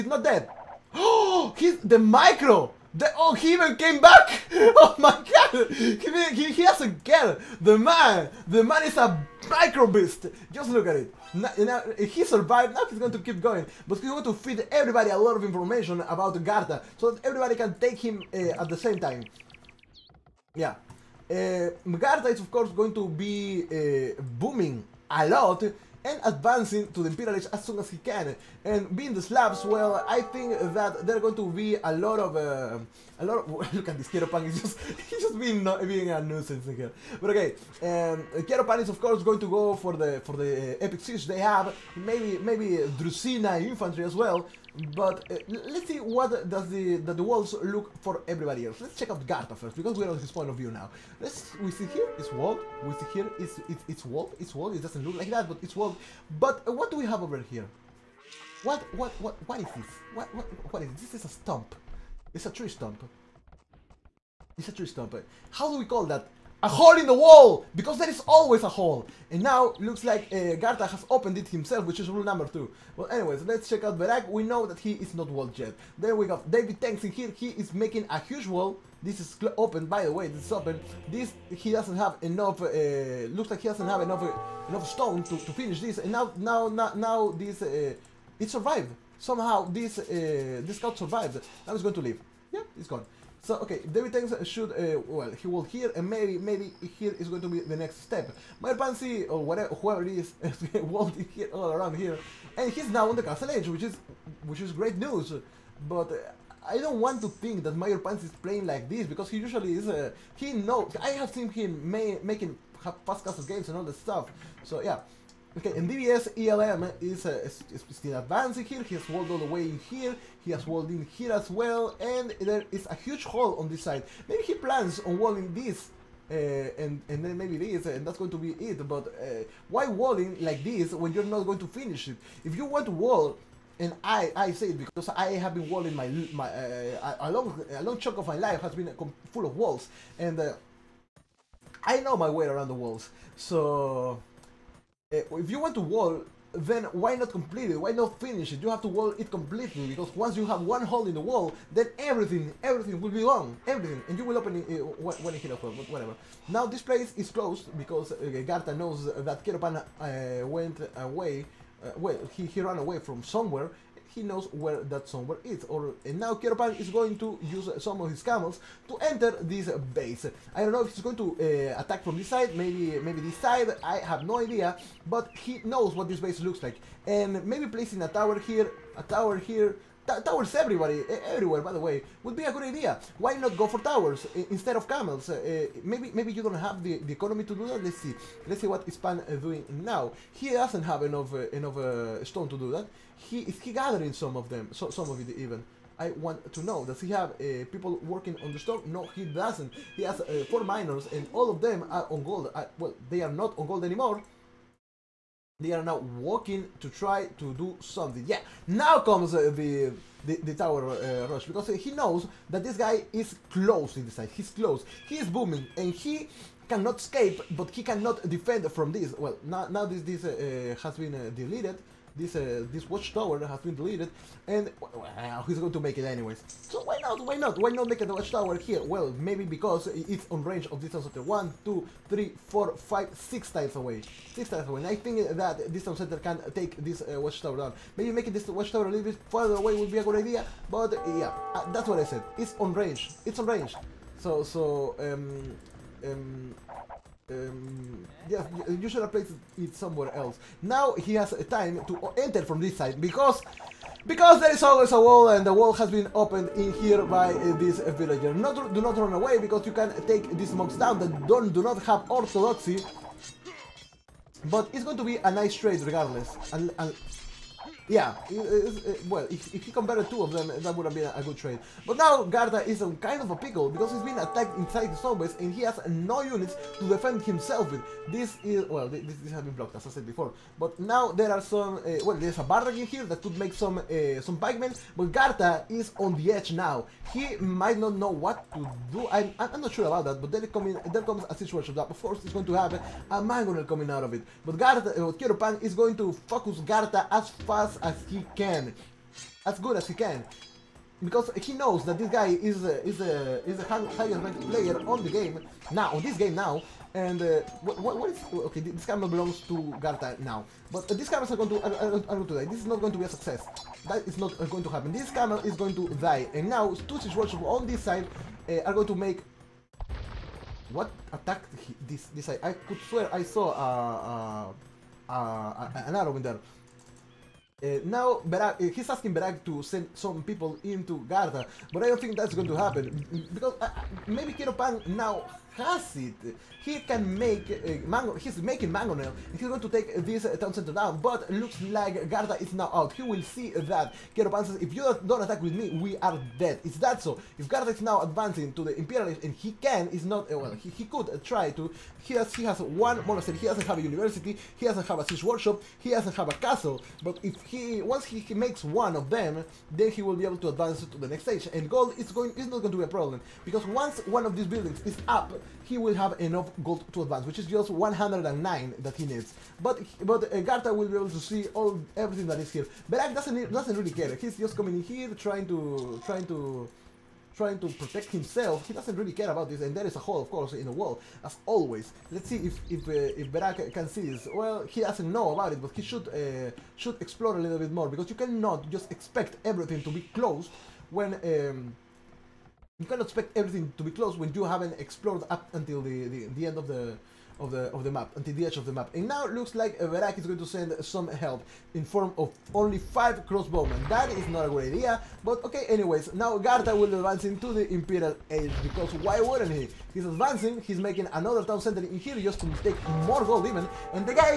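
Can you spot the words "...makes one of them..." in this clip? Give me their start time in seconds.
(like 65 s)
358 s.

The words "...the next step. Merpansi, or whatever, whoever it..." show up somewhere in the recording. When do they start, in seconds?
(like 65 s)
97 s.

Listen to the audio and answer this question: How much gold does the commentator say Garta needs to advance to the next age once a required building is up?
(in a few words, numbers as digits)
109.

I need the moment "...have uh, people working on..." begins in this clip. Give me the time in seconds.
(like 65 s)
197 s.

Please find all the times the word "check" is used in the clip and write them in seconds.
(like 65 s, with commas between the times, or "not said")
48 s, 73 s.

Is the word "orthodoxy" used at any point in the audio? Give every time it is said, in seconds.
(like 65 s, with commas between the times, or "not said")
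262 s.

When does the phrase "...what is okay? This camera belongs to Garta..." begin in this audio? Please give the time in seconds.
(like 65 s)
307 s.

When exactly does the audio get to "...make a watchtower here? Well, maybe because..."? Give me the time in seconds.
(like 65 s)
227 s.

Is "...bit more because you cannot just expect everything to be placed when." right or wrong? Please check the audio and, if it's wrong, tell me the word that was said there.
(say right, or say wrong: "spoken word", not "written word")
wrong: "closed", not "placed".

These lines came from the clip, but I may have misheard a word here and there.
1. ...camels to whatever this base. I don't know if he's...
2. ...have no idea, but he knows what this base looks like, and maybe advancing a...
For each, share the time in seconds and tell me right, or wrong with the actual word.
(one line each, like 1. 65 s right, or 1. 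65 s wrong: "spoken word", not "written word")
1. 168 s wrong: "enter", not "whatever"
2. 173 s wrong: "placing", not "advancing".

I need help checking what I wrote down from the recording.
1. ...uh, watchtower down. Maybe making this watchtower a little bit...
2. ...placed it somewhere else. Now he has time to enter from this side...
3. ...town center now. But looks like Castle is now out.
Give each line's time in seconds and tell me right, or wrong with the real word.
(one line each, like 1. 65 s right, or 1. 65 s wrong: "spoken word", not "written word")
1. 237 s right
2. 249 s right
3. 340 s wrong: "Garta", not "Castle".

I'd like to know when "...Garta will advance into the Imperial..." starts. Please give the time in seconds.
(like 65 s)
406 s.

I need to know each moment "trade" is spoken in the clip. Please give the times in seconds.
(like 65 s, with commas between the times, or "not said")
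265 s, 271 s.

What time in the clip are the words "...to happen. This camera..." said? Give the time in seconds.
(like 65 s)
314 s.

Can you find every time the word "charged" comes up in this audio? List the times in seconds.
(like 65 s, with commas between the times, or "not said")
not said.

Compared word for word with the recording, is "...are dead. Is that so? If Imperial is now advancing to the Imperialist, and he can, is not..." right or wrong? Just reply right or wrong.
wrong.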